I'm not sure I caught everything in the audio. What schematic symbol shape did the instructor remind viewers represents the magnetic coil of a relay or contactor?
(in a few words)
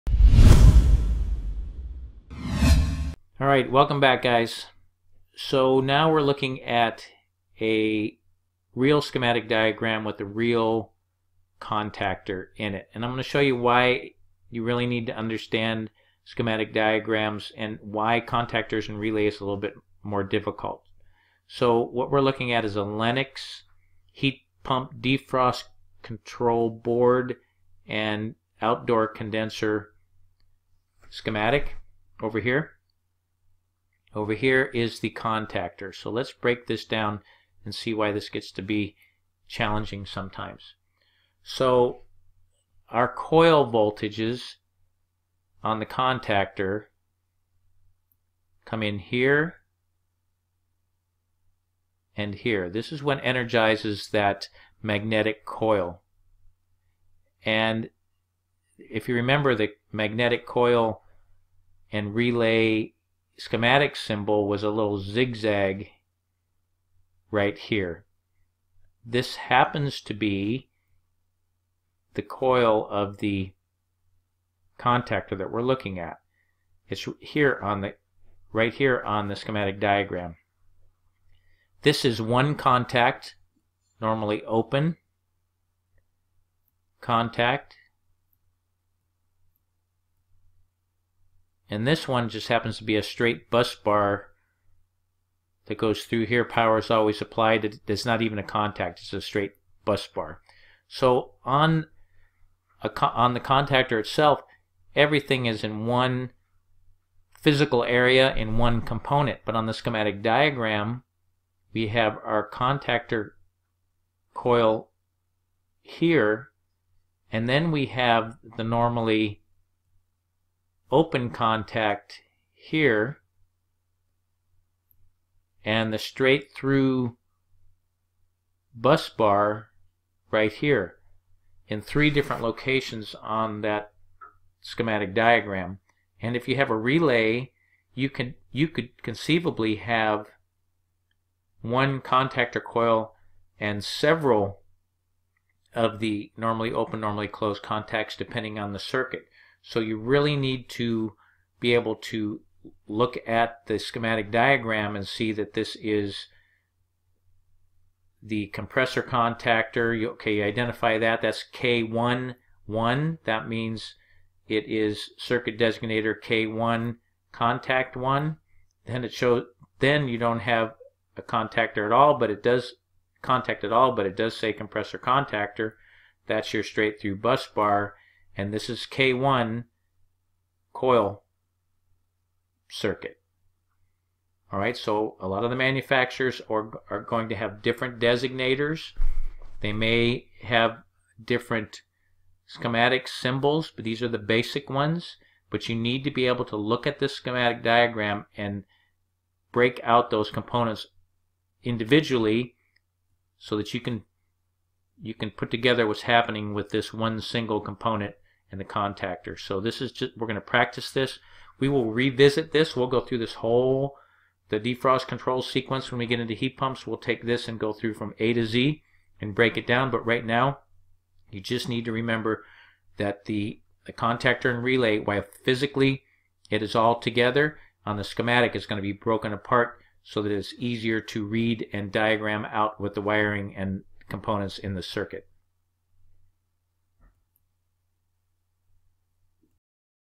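Zigzag.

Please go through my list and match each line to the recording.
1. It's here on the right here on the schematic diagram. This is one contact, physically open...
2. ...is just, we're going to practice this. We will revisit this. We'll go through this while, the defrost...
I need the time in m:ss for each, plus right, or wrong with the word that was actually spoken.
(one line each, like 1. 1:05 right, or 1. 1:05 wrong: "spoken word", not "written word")
1. 1:16 wrong: "normally", not "physically"
2. 3:29 wrong: "whole", not "while".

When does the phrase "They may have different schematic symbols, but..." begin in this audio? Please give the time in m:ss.
3:09.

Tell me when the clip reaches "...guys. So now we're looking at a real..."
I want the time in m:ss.
0:04.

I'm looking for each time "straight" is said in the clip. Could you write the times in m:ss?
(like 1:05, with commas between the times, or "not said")
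1:33, 1:39, 2:05, 2:56.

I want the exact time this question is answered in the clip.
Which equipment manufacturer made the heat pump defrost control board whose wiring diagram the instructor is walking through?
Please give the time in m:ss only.
0:22.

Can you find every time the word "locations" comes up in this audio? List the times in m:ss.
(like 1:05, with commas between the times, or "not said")
2:12.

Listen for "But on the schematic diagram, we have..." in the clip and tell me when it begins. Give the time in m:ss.
1:49.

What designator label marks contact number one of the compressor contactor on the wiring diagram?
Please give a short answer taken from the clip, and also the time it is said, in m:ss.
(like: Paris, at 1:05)
K1, 1, at 2:41.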